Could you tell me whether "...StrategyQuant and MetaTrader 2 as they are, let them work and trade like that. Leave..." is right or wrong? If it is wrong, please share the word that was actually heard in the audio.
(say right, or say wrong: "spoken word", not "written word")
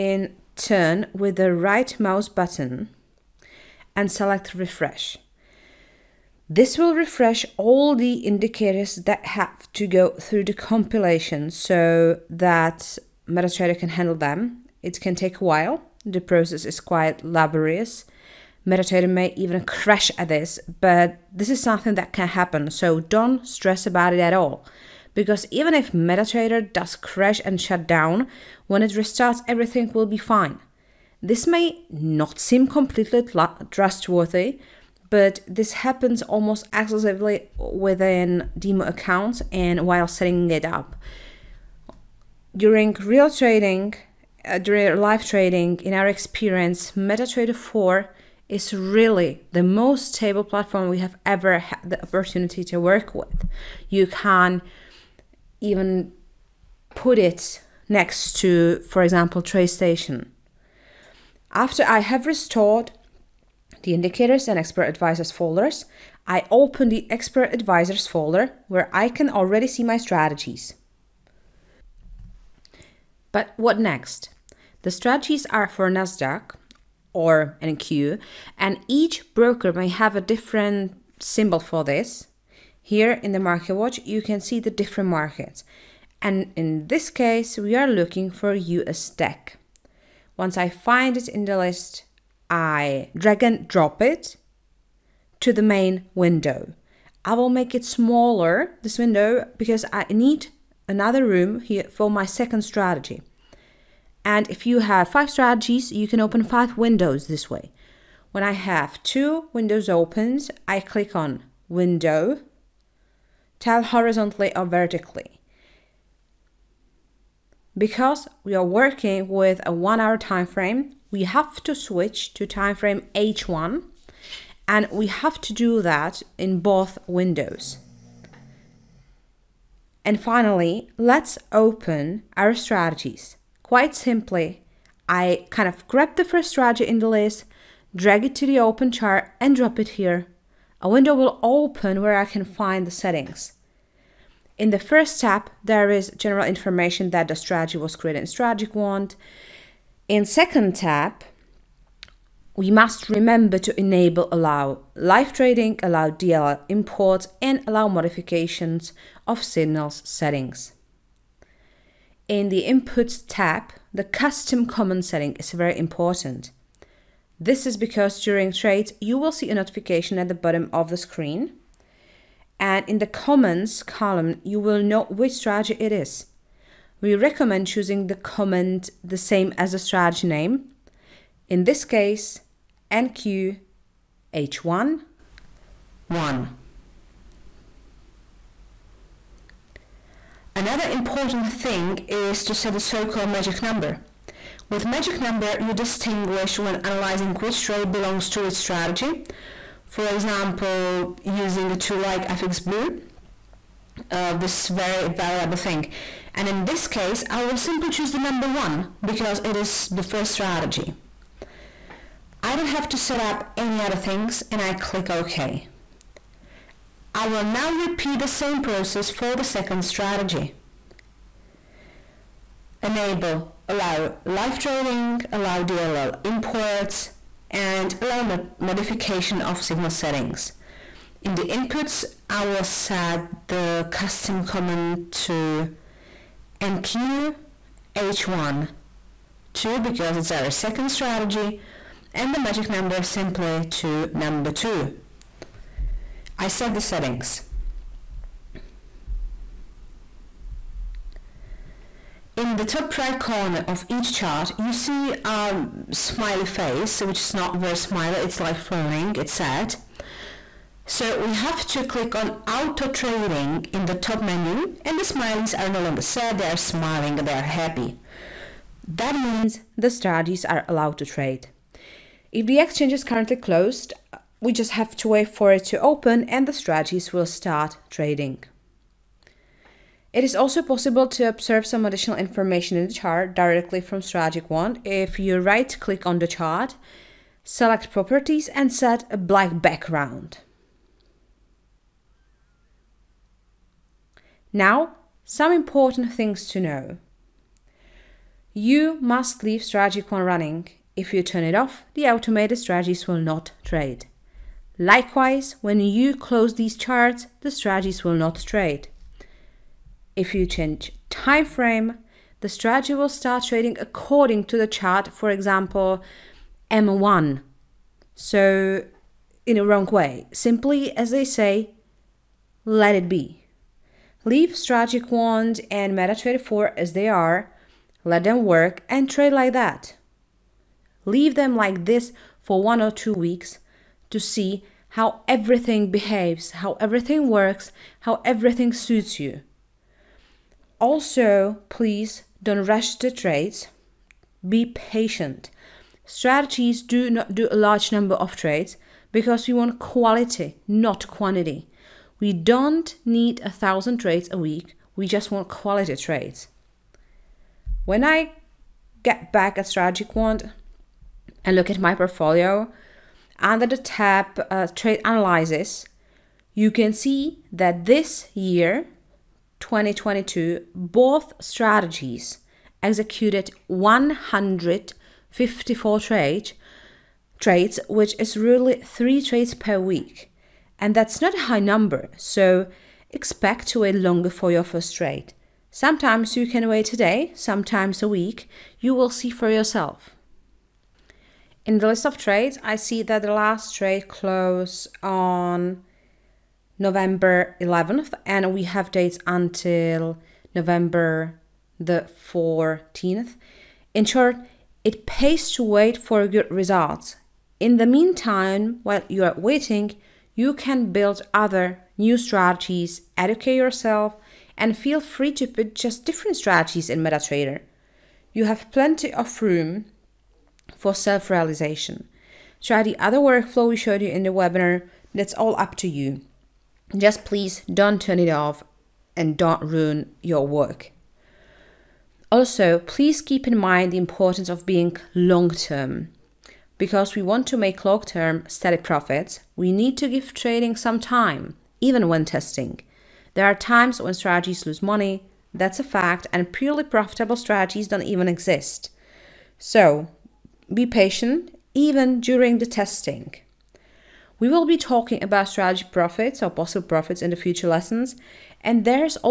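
wrong: "4", not "2".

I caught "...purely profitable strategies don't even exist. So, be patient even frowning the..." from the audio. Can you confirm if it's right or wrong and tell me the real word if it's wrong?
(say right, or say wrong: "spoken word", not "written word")
wrong: "during", not "frowning".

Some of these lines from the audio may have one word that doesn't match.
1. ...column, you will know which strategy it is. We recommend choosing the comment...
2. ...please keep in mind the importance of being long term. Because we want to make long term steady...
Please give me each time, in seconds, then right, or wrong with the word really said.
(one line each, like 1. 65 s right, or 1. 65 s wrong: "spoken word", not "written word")
1. 173 s right
2. 432 s right.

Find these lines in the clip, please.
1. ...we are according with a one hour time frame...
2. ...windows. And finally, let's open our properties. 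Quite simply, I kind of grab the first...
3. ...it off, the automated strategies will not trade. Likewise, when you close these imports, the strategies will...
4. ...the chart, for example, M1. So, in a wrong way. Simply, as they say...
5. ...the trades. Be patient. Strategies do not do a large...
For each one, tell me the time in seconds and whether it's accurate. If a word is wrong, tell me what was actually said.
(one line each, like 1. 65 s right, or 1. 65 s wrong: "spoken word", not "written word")
1. 118 s wrong: "working", not "according"
2. 127 s wrong: "strategies", not "properties"
3. 301 s wrong: "charts", not "imports"
4. 314 s right
5. 342 s right.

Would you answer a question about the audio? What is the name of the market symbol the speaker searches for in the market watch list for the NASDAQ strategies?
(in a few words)
US tech.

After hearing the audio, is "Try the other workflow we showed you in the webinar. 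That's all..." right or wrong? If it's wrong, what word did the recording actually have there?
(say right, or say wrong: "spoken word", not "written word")
right.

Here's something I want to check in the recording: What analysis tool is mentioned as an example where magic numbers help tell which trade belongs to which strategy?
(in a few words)
FX Blue.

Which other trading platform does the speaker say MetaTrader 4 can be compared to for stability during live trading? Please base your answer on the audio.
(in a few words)
TradeStation.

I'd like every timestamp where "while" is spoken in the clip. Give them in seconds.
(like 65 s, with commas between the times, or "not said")
15 s, 39 s, 408 s.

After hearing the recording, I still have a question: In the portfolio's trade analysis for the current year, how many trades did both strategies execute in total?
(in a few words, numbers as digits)
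154.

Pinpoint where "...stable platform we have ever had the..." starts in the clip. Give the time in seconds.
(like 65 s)
50 s.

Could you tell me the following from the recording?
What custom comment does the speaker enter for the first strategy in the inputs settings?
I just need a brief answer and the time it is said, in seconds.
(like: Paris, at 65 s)
NQ H1 1, at 182 s.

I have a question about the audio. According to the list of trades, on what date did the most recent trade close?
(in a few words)
November 11th.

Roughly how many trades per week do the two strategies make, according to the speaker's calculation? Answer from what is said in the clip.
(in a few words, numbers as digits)
3.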